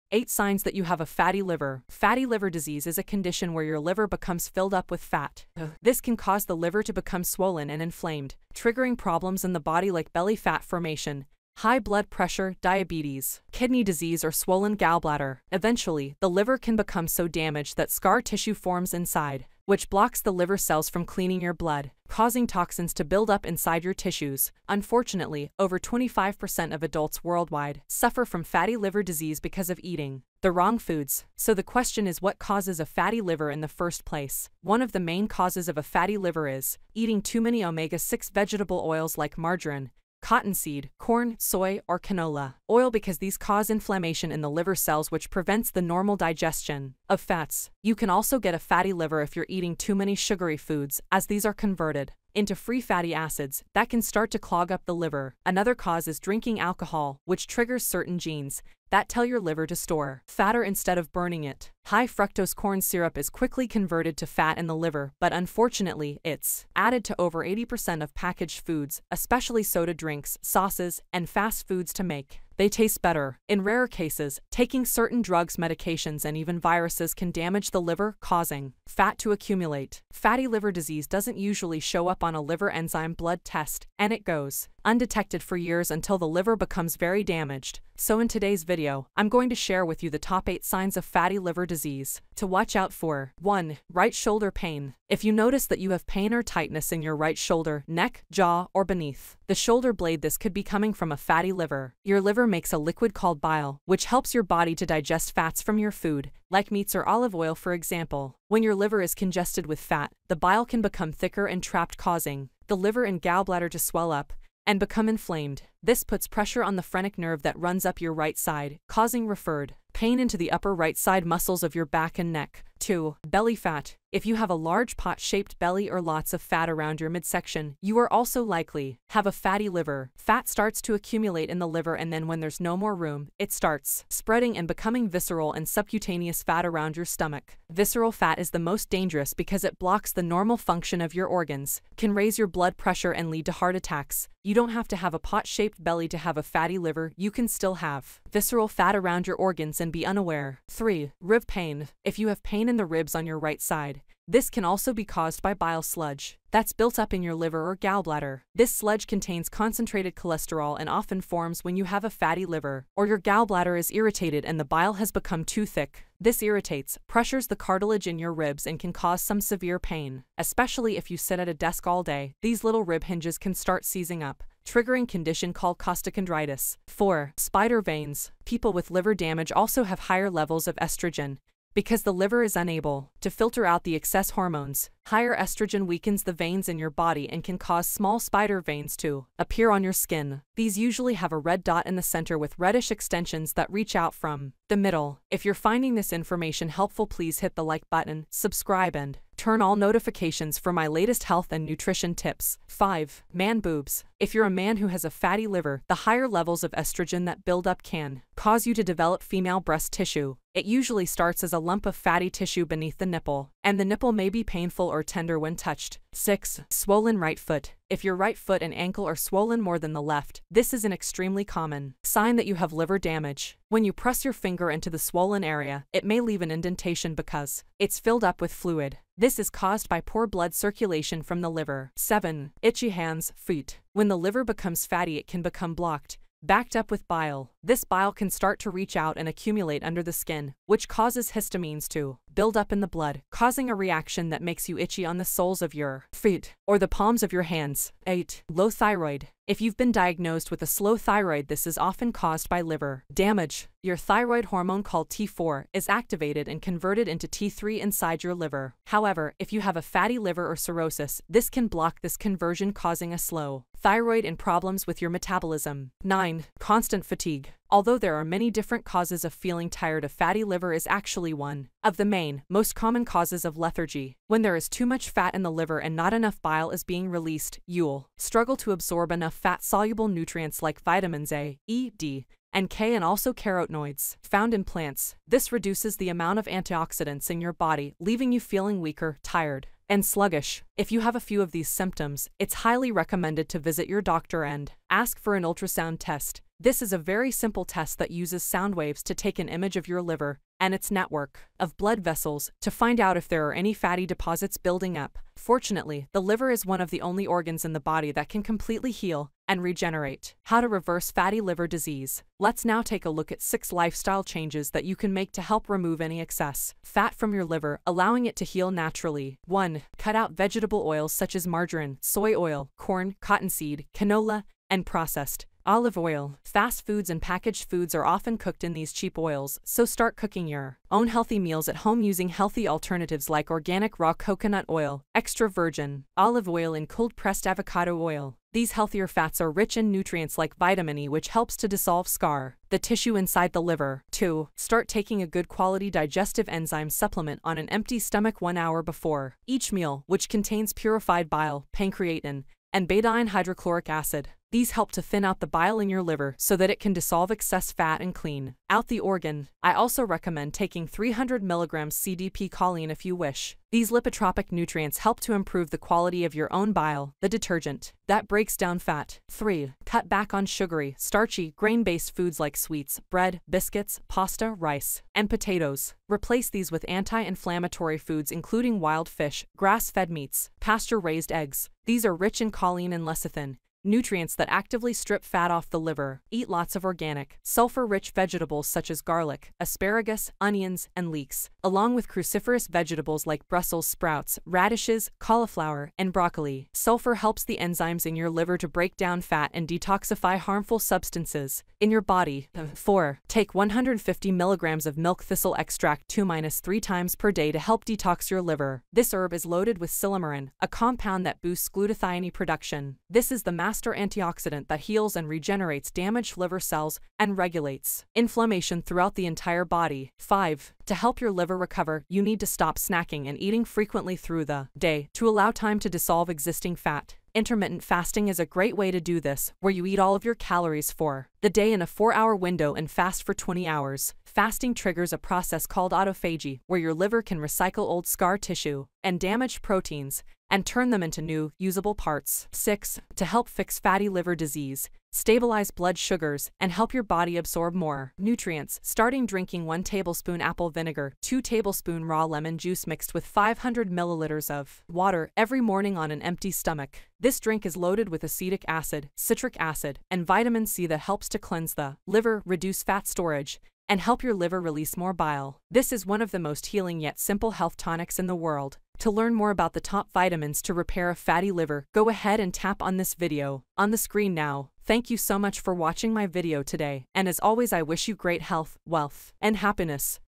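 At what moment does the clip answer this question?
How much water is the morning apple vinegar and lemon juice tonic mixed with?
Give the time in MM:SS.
07:33.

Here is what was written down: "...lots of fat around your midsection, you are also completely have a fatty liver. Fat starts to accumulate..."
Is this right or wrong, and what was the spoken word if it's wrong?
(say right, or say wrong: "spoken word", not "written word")
wrong: "likely", not "completely".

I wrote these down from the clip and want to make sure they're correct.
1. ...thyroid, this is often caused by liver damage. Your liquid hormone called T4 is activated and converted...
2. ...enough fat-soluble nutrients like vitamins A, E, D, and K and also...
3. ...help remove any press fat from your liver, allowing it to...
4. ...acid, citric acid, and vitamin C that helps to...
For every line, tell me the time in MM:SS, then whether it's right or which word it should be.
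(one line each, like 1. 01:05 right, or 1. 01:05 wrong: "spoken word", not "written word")
1. 04:10 wrong: "thyroid", not "liquid"
2. 04:39 right
3. 05:15 wrong: "excess", not "press"
4. 07:38 right.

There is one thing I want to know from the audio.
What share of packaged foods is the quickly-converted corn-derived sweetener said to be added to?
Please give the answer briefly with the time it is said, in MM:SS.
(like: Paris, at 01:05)
80%, at 01:07.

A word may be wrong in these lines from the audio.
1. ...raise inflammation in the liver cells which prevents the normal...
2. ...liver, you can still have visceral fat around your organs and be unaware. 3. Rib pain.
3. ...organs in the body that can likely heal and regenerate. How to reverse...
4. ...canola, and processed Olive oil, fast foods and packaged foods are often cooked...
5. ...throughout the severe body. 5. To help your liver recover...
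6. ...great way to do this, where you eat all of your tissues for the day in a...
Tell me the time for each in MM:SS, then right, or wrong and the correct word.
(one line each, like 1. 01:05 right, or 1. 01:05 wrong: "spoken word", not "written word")
1. 00:43 wrong: "cause", not "raise"
2. 02:26 right
3. 05:07 wrong: "completely", not "likely"
4. 05:23 right
5. 06:58 wrong: "entire", not "severe"
6. 07:08 wrong: "calories", not "tissues".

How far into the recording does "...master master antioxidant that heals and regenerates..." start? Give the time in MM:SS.
06:53.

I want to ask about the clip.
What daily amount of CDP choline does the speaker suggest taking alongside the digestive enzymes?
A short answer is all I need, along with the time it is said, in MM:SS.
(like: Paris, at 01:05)
300 mg, at 06:00.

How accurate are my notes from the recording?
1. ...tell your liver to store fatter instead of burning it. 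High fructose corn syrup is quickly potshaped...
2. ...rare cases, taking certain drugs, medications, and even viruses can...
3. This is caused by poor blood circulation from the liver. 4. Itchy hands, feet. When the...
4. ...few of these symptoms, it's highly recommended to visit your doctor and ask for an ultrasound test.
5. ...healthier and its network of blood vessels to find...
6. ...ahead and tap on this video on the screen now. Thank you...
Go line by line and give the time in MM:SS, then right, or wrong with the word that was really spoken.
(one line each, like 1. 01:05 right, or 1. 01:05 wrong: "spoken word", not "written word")
1. 00:59 wrong: "converted", not "potshaped"
2. 01:13 right
3. 03:49 wrong: "7", not "4"
4. 04:51 right
5. 05:00 wrong: "liver", not "healthier"
6. 07:52 right.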